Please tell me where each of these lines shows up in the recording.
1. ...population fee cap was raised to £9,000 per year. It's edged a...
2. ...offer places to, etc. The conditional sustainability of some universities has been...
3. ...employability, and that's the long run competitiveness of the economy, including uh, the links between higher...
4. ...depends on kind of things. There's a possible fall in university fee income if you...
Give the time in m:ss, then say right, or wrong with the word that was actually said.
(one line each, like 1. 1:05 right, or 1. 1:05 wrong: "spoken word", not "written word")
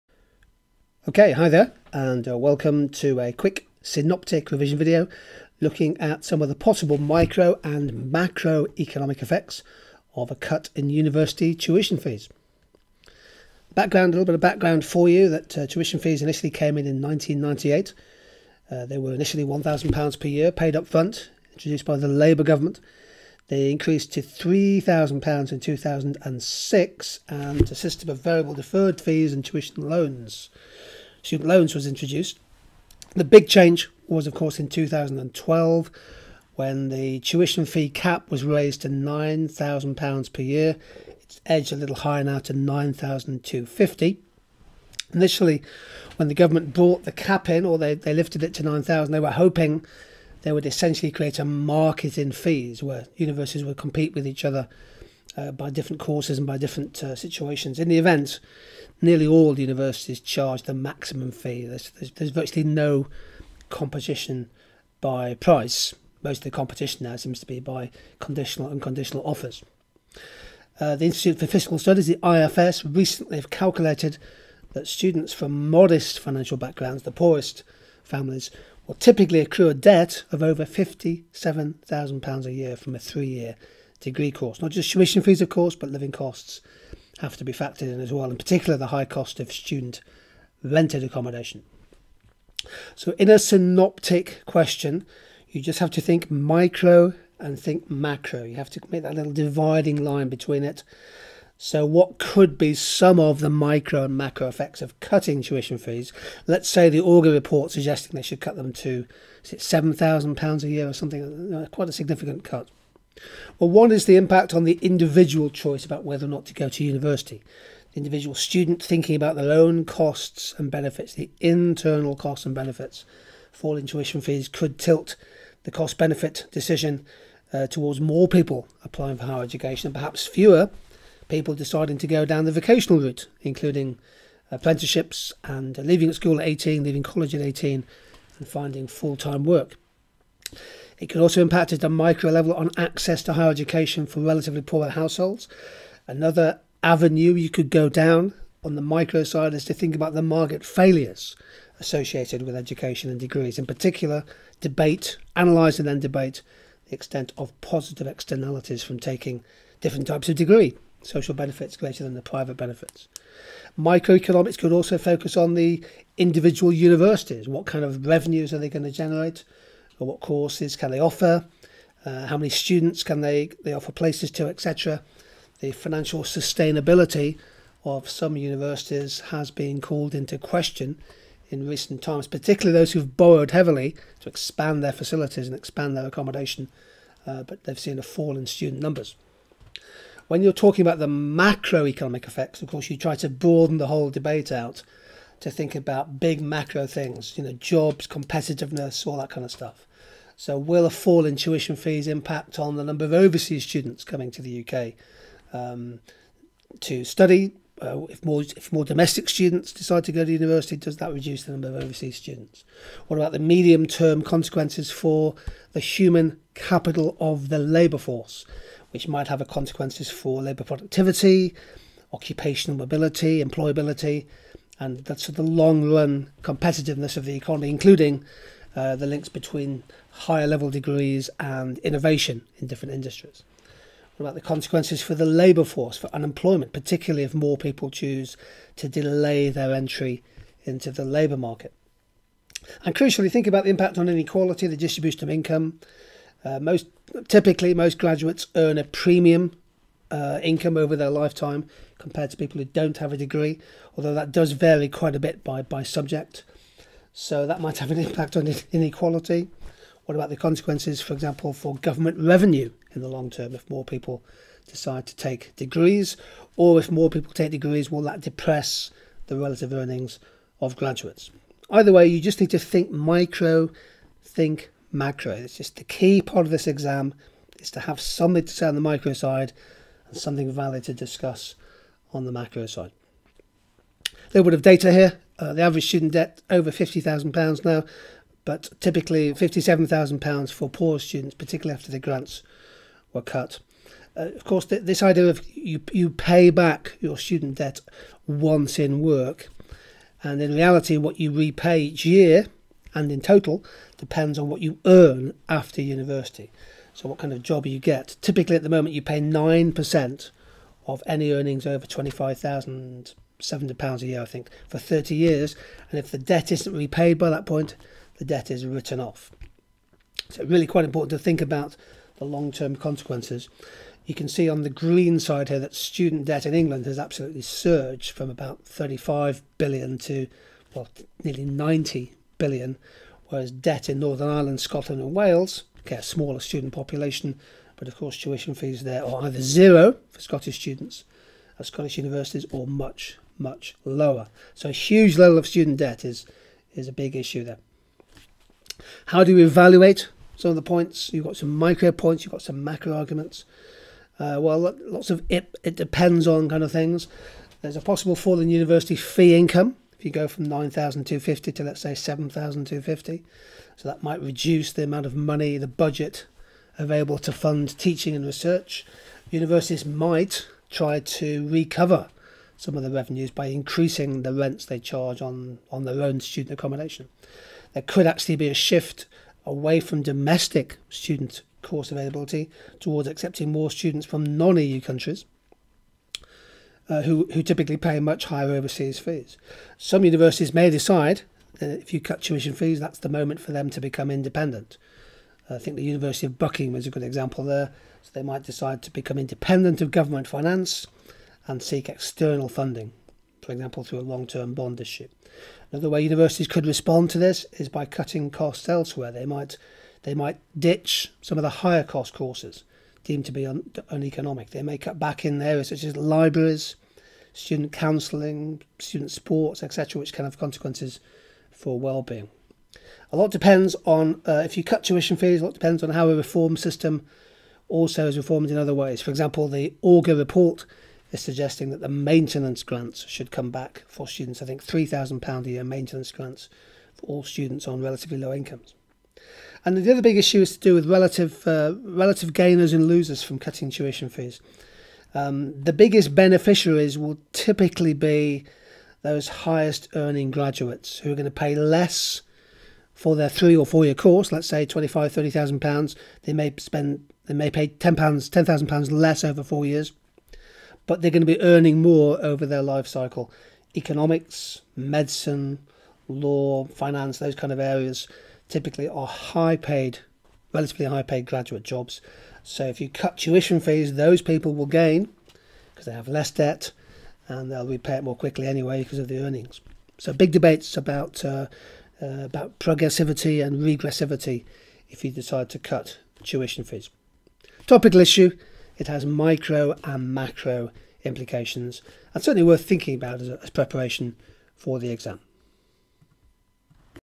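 1. 0:37 wrong: "tuition", not "population"
2. 2:53 wrong: "financial", not "conditional"
3. 3:43 right
4. 5:55 right.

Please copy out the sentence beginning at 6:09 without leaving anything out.
Universities might try to recover some of the revenues by increasing the rents they charge on, on their own student accommodation.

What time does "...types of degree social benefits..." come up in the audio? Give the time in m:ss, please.
2:40.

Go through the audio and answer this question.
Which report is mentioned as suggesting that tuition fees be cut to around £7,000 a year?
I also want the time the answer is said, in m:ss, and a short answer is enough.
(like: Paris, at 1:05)
Augar report, at 1:47.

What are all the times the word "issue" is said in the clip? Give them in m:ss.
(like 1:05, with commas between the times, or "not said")
5:47, 6:44, 7:20, 8:08.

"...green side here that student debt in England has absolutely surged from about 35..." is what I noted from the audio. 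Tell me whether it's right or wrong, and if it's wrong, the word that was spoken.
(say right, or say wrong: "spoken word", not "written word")
right.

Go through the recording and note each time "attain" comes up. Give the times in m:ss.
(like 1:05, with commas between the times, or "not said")
not said.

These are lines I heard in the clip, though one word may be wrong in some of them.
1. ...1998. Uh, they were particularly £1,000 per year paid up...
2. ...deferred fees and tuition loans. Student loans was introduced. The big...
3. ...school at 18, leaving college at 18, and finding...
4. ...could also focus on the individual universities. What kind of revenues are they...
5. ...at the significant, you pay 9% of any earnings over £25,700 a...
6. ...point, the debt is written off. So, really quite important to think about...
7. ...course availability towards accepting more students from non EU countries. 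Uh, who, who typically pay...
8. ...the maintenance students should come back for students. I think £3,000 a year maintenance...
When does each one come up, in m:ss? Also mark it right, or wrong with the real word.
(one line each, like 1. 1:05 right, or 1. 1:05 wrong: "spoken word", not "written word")
1. 0:17 wrong: "initially", not "particularly"
2. 0:28 right
3. 2:16 right
4. 2:44 right
5. 5:08 wrong: "moment", not "significant"
6. 5:17 right
7. 6:21 right
8. 7:11 wrong: "grants", not "students".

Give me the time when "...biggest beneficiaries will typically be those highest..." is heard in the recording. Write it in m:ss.
7:25.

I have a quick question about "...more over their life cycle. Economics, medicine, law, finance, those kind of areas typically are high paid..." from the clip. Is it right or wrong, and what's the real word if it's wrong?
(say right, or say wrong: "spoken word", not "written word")
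right.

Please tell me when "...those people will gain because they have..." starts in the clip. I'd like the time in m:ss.
7:53.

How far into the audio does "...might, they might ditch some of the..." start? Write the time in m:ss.
6:49.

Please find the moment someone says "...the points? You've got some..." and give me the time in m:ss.
5:50.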